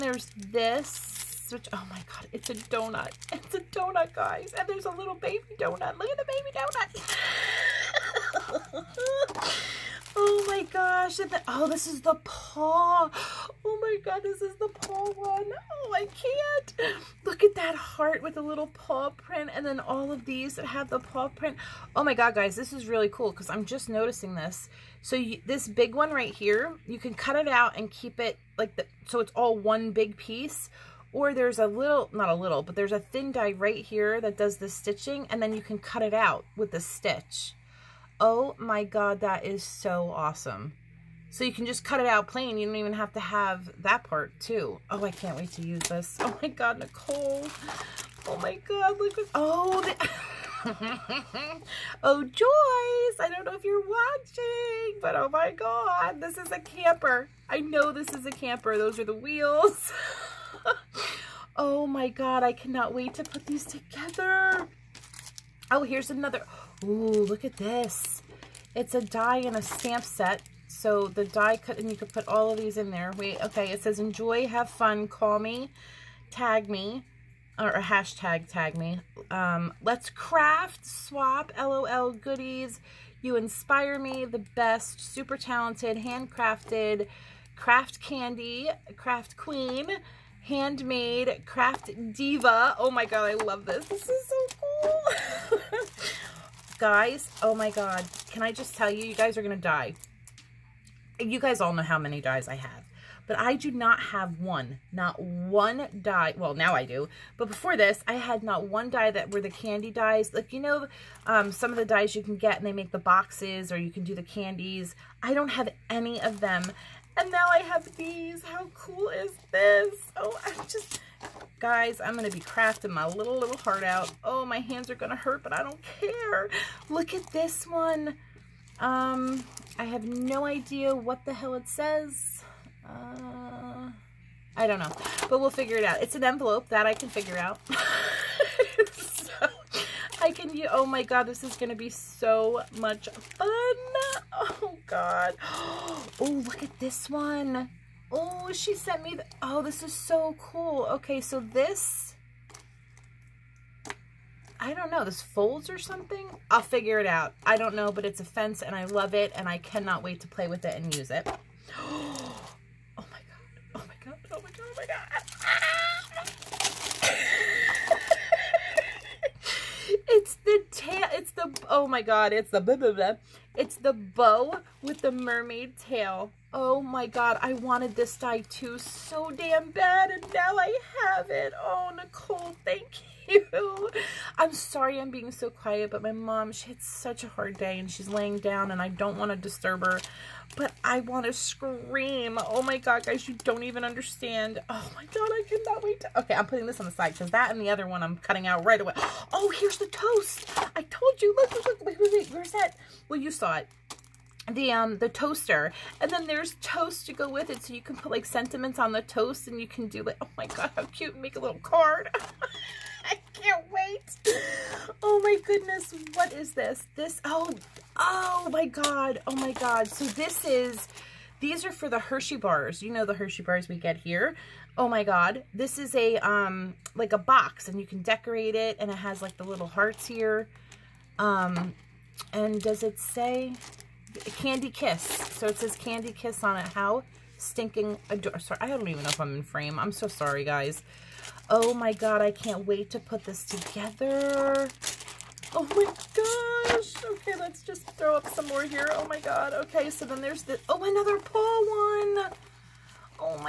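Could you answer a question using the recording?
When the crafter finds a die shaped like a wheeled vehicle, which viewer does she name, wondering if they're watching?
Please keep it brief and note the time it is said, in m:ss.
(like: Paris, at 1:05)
Joyce, at 0:52.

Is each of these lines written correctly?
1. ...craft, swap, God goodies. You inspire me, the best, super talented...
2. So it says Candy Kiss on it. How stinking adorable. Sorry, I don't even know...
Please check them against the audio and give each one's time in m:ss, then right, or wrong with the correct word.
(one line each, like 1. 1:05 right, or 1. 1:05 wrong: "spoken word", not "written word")
1. 1:20 wrong: "LOL", not "God"
2. 3:55 right.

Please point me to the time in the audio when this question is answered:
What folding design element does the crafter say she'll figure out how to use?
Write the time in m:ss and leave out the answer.
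2:38.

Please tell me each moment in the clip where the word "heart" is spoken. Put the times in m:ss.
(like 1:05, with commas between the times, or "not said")
0:17, 2:03, 3:49.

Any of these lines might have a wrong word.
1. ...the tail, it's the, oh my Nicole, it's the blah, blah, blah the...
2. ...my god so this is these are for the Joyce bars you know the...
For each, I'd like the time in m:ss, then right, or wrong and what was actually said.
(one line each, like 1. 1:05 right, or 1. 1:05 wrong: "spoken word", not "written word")
1. 2:50 wrong: "God", not "Nicole"
2. 3:39 wrong: "Hershey", not "Joyce".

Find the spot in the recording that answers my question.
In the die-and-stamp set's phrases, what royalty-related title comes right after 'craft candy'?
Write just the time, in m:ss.
1:28.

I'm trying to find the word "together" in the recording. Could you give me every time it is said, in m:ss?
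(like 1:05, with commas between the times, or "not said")
1:03, 4:03.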